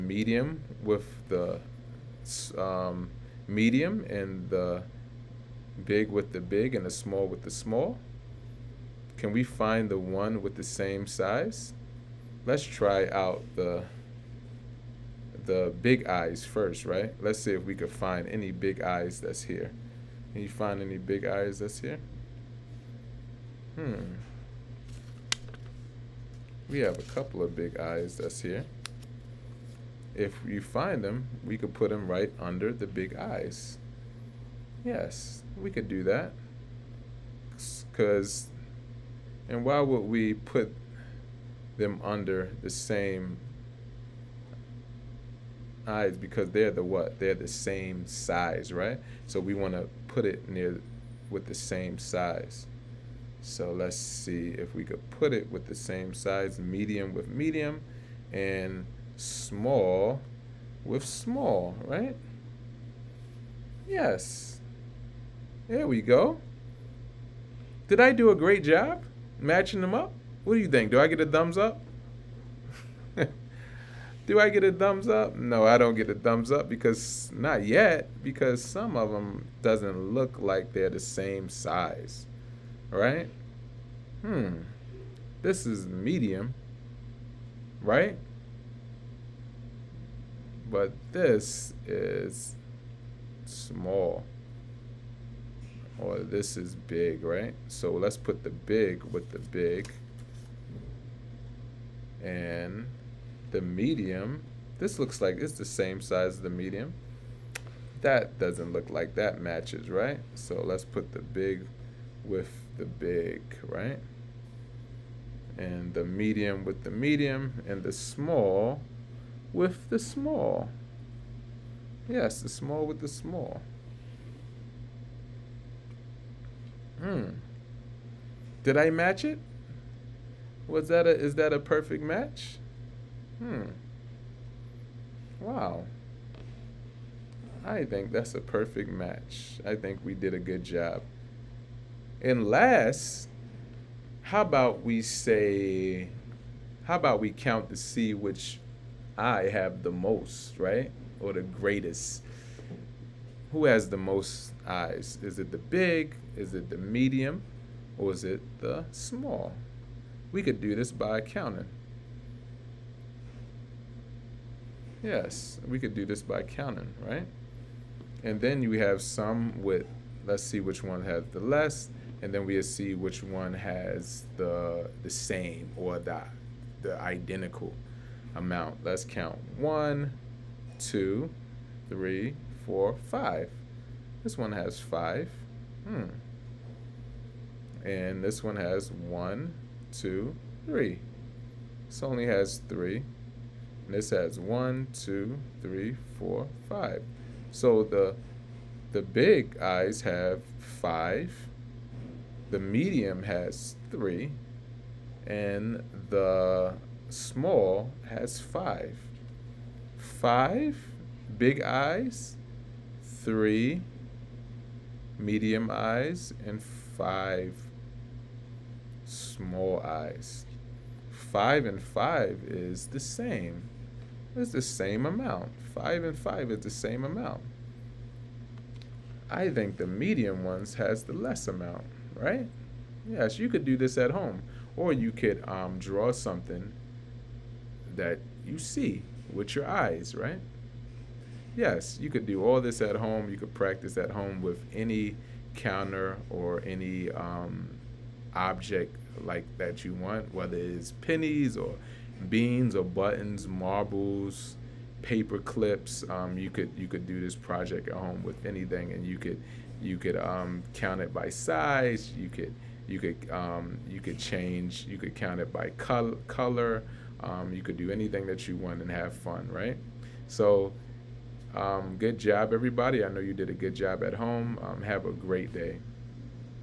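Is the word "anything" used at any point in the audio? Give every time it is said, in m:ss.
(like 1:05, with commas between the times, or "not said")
4:18, 4:27.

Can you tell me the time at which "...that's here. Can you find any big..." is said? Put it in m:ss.
0:19.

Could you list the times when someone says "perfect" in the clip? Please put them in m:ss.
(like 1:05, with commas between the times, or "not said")
2:11, 2:18.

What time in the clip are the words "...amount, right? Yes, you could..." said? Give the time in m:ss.
3:51.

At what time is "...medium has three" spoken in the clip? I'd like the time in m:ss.
3:22.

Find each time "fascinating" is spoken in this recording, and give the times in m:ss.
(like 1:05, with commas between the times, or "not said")
not said.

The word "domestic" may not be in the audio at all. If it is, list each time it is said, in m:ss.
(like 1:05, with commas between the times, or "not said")
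not said.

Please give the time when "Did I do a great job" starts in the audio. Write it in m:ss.
1:07.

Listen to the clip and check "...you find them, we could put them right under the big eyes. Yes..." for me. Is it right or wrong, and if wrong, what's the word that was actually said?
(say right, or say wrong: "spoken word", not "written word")
right.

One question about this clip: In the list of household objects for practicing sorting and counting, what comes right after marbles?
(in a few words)
paper clips.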